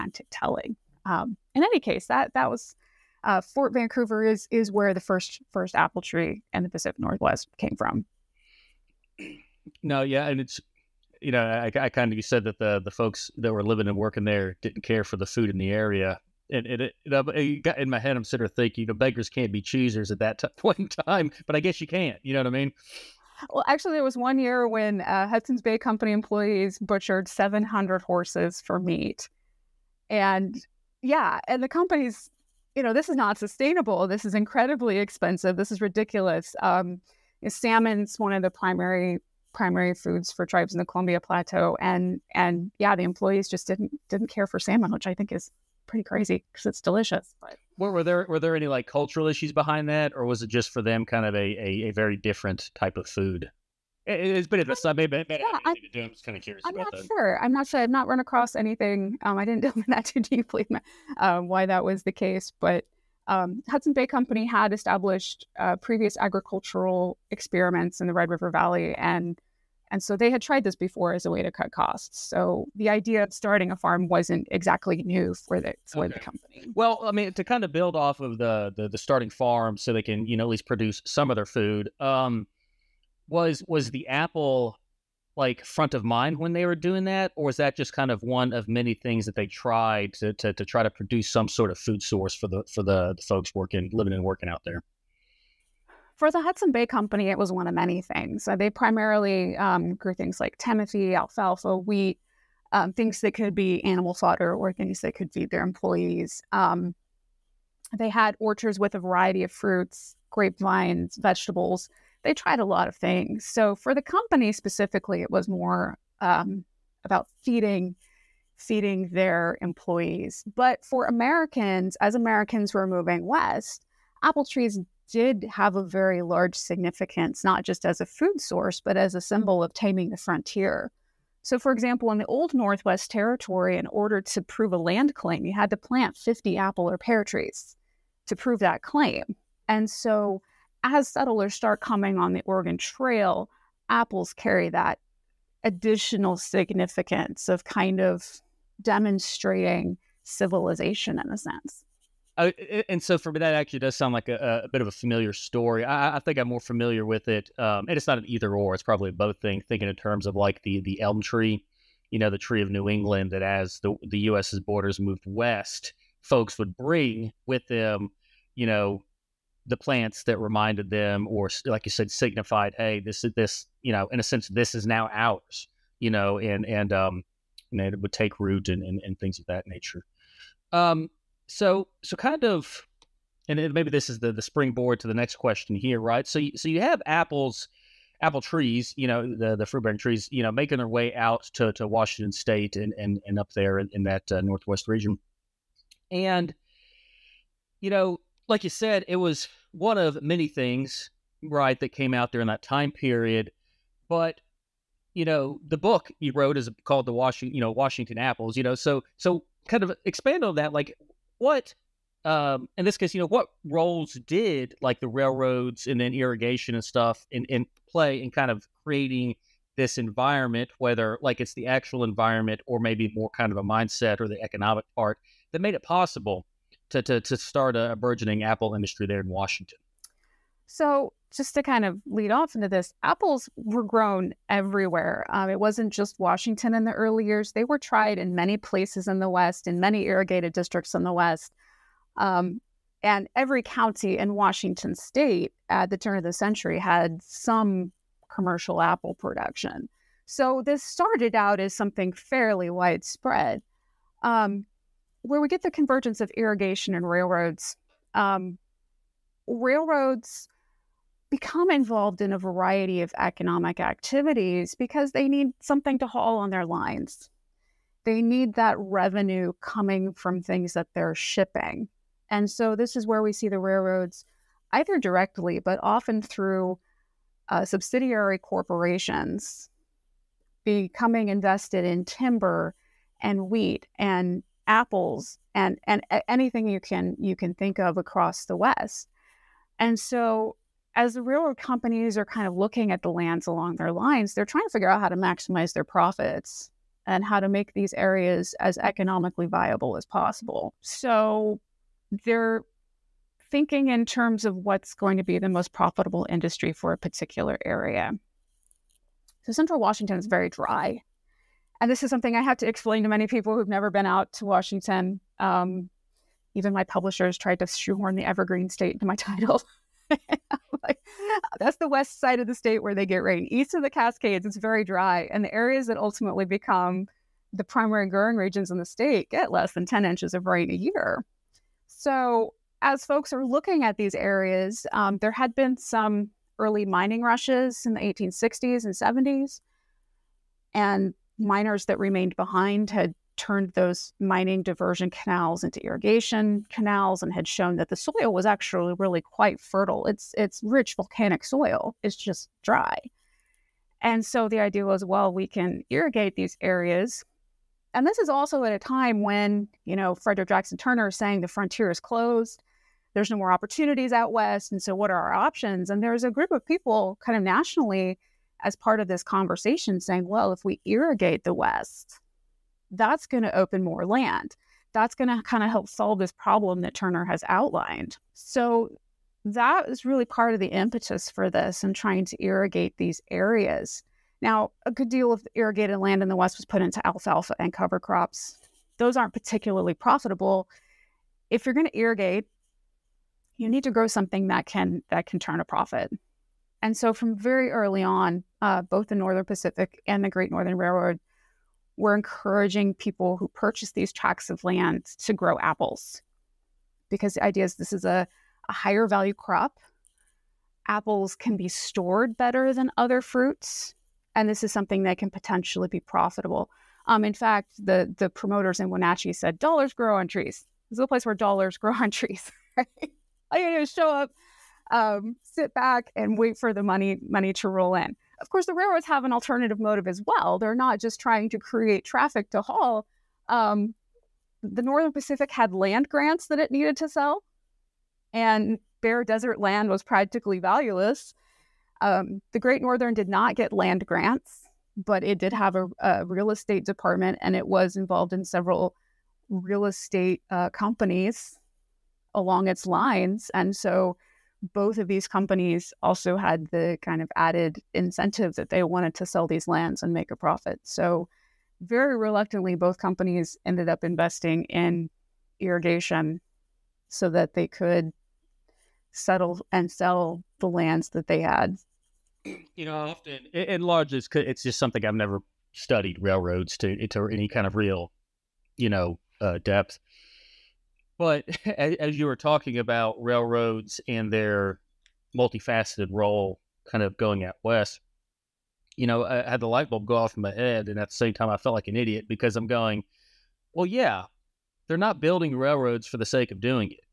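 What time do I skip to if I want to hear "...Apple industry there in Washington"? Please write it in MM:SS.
03:48.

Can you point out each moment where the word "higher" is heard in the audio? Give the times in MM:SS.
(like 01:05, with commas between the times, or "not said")
06:48.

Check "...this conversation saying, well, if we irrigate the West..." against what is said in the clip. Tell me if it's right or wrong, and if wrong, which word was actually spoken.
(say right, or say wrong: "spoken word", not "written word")
right.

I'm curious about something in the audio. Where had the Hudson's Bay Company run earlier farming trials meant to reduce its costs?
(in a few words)
Red River Valley.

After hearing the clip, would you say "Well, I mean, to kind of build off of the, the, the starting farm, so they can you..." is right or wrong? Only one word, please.
right.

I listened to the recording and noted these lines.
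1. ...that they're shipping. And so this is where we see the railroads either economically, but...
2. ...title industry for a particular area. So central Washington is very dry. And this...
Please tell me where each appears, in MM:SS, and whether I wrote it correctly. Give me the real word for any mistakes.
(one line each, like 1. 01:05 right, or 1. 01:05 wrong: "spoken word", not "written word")
1. 04:30 wrong: "directly", not "economically"
2. 05:05 wrong: "profitable", not "title".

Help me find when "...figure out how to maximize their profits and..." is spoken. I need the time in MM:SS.
04:54.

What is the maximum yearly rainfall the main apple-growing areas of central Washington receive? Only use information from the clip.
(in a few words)
10 inches.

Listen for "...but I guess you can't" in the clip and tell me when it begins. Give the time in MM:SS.
00:21.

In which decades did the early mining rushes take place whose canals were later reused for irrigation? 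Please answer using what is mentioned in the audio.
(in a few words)
1860s and 70s.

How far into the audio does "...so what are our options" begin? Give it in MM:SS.
06:04.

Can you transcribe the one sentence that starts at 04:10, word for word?
So this started out as something fairly widespread.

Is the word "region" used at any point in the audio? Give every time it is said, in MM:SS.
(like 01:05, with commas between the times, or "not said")
03:14, 05:28.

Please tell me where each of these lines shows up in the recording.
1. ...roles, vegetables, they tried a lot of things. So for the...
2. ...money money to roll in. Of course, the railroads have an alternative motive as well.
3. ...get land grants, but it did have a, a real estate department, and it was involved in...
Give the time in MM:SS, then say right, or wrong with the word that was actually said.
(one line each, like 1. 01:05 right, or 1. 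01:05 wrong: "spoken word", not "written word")
1. 01:50 wrong: "grapevines", not "roles"
2. 07:06 right
3. 07:23 right.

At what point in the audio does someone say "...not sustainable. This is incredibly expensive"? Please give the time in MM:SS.
00:33.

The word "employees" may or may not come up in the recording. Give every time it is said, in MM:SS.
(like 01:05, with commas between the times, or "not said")
00:26, 00:43, 01:45, 01:59.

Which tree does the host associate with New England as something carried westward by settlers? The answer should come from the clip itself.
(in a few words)
elm.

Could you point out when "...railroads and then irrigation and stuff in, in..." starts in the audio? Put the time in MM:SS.
03:35.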